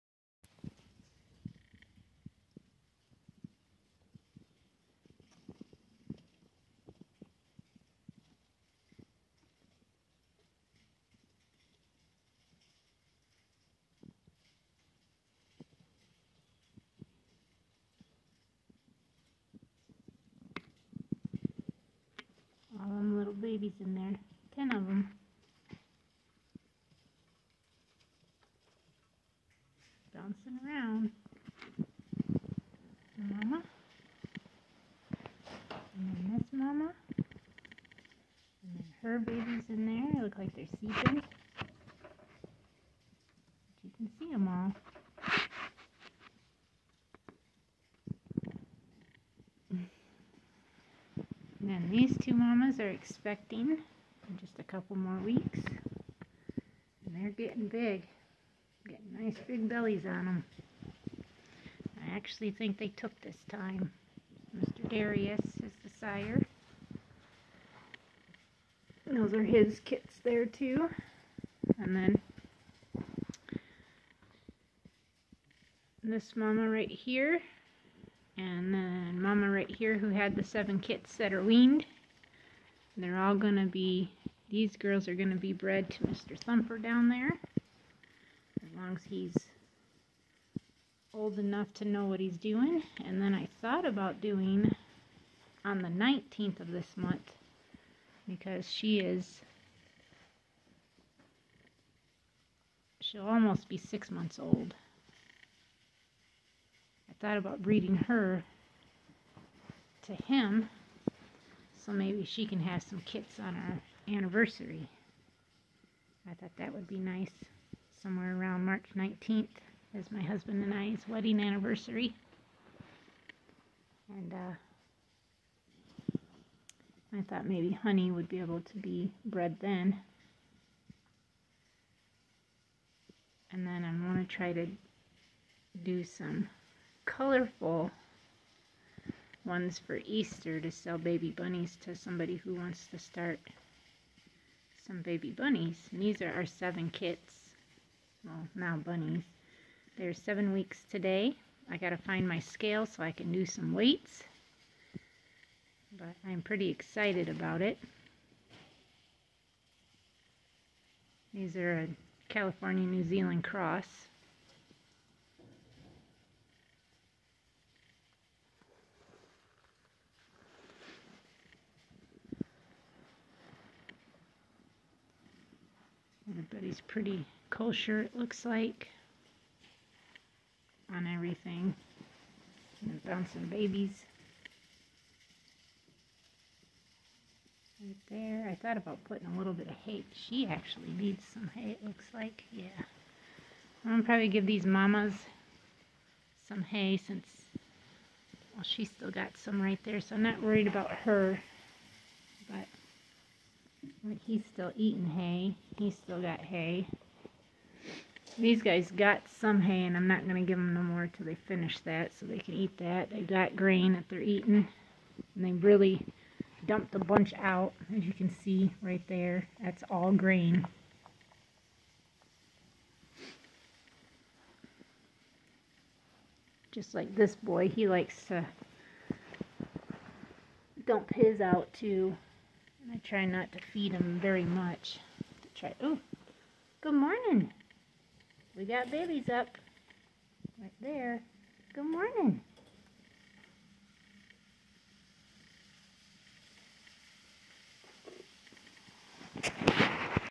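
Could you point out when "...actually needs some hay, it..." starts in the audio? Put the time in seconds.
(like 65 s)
190 s.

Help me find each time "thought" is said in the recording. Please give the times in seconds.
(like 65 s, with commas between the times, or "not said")
93 s, 107 s, 116 s, 127 s, 188 s.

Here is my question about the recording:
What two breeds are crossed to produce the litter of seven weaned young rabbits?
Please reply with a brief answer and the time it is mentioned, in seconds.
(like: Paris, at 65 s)
California New Zealand cross, at 162 s.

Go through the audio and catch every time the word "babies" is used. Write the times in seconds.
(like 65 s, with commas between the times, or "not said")
23 s, 39 s, 183 s, 238 s.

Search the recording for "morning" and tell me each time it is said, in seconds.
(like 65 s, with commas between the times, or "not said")
236 s, 241 s.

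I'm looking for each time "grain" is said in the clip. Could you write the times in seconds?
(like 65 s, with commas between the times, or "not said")
213 s, 220 s.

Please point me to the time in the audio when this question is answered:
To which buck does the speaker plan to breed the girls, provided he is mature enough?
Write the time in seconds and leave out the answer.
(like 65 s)
86 s.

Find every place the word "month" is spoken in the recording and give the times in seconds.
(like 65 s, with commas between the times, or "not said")
96 s, 104 s.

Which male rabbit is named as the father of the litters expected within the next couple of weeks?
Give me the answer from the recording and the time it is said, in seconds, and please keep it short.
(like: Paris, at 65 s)
Mr. Darius, at 64 s.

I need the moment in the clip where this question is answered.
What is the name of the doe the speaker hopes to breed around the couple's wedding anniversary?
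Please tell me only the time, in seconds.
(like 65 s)
127 s.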